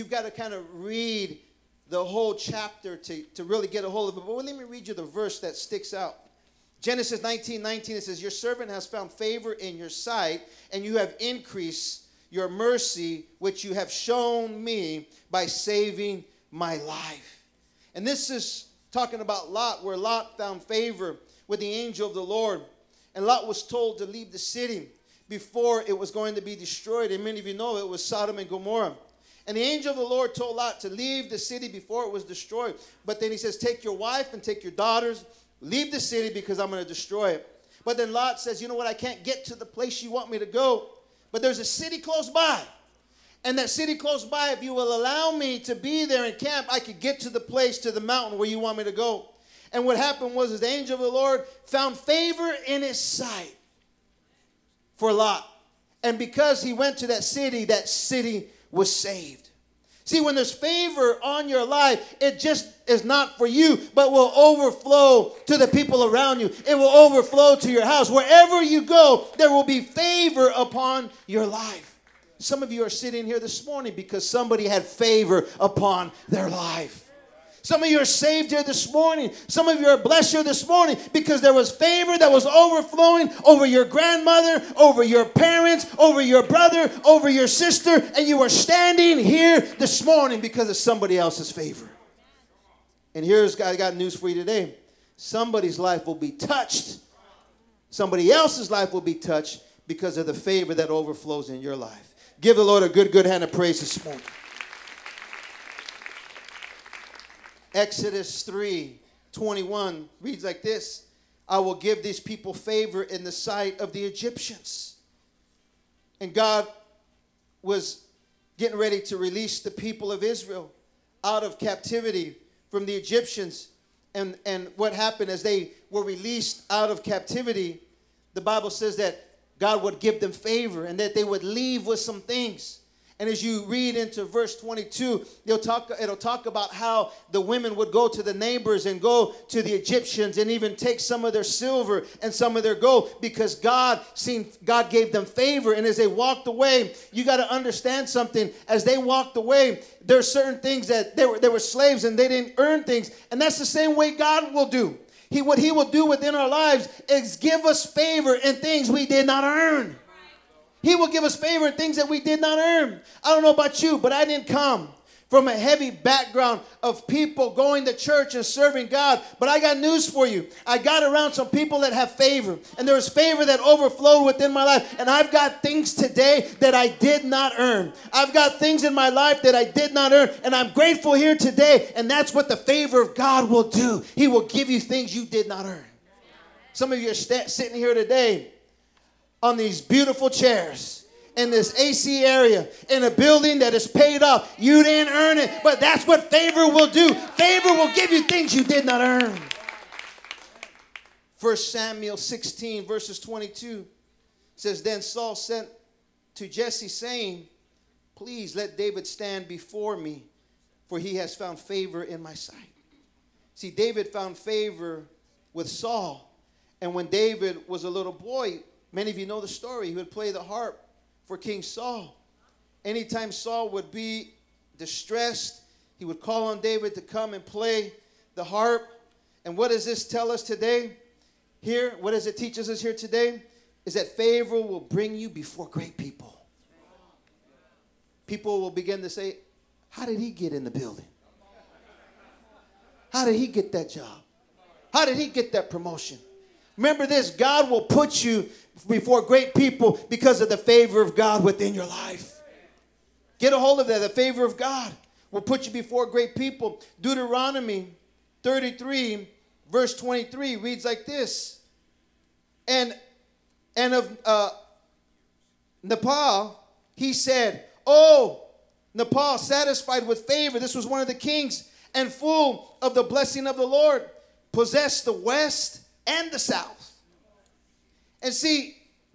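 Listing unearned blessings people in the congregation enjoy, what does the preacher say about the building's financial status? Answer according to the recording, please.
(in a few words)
paid off.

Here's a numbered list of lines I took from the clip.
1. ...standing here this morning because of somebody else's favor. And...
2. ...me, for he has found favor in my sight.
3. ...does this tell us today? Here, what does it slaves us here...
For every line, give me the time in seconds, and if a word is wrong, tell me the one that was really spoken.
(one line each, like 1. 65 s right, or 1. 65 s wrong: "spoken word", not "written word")
1. 88 s right
2. 209 s right
3. 229 s wrong: "teaches", not "slaves".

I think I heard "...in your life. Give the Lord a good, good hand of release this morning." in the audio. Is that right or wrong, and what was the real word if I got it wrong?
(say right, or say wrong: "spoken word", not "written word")
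wrong: "praise", not "release".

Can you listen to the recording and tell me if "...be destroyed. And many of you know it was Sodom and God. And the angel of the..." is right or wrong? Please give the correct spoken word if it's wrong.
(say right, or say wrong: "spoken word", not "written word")
wrong: "Gomorrah", not "God".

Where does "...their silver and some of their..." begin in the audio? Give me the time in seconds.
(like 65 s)
141 s.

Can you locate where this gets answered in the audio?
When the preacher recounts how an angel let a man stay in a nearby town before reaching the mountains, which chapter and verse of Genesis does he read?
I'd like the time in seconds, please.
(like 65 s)
6 s.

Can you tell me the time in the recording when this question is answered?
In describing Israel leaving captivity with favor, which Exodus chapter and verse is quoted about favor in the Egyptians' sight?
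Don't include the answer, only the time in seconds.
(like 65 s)
107 s.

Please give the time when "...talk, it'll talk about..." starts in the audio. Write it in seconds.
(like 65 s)
135 s.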